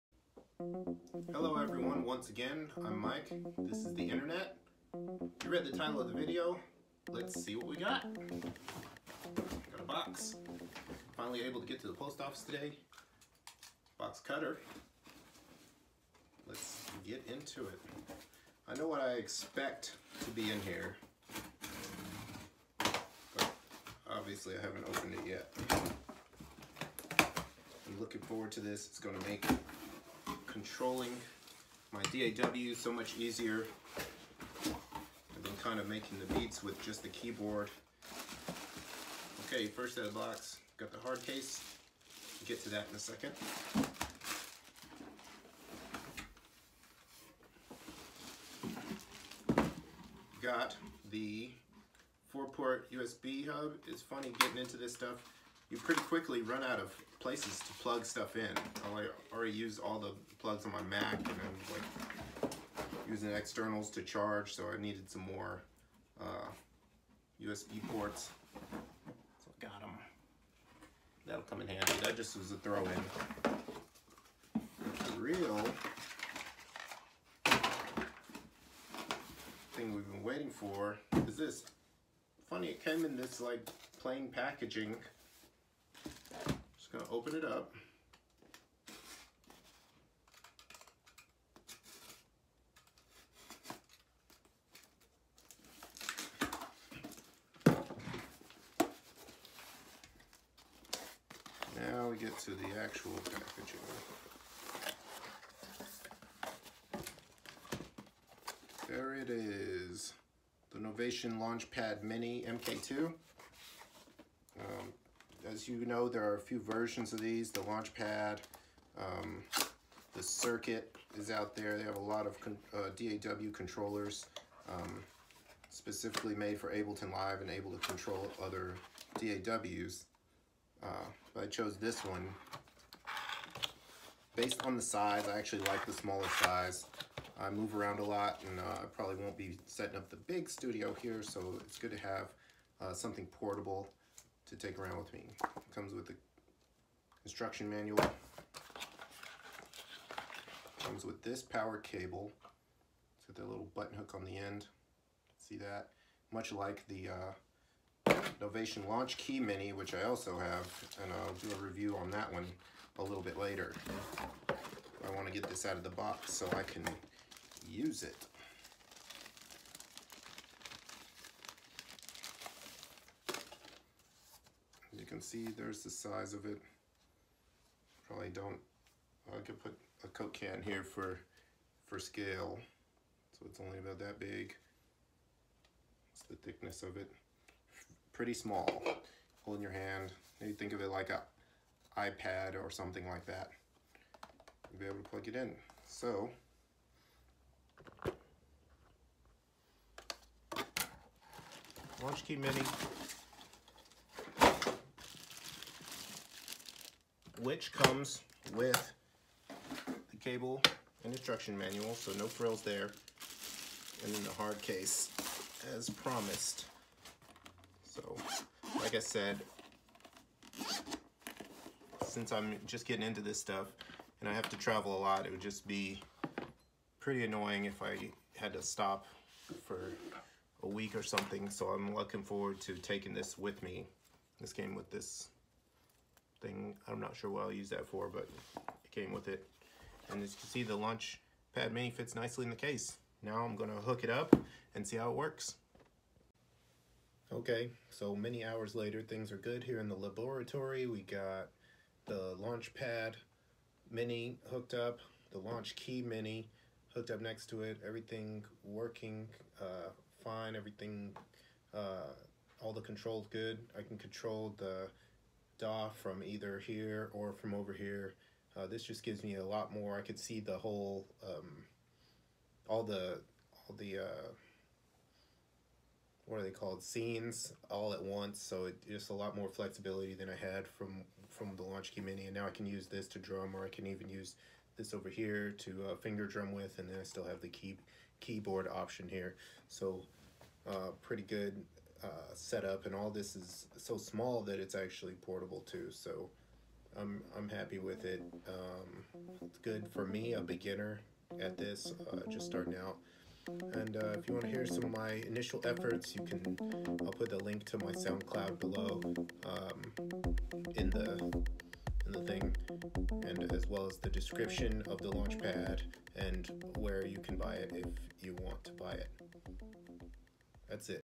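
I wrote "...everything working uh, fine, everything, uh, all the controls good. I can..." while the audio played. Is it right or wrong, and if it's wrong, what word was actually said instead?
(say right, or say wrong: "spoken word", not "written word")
right.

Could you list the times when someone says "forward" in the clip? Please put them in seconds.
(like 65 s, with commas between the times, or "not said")
28 s, 232 s.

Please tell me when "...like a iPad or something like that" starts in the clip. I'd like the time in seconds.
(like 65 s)
190 s.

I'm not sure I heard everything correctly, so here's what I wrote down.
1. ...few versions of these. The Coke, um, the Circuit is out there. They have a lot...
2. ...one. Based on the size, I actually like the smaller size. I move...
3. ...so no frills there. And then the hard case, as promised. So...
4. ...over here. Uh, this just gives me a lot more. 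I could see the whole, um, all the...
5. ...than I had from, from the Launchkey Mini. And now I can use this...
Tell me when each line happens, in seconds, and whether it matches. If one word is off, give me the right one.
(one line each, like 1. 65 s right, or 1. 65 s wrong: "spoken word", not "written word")
1. 116 s wrong: "Launchpad", not "Coke"
2. 132 s right
3. 211 s right
4. 267 s right
5. 280 s right.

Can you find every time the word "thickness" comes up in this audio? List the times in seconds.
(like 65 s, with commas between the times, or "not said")
186 s.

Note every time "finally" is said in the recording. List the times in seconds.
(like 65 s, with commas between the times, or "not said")
11 s.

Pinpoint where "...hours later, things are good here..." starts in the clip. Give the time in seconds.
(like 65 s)
248 s.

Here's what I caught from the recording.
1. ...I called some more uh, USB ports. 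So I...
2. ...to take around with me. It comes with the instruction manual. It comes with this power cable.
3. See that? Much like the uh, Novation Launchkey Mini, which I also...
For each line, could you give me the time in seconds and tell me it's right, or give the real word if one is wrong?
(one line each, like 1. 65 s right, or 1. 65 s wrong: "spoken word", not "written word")
1. 64 s wrong: "needed", not "called"
2. 144 s right
3. 155 s right.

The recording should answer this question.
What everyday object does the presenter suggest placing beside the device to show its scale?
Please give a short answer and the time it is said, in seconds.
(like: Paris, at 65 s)
A Coke can, at 180 s.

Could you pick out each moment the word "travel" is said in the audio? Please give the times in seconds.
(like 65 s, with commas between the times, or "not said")
224 s.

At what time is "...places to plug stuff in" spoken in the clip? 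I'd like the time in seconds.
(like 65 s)
57 s.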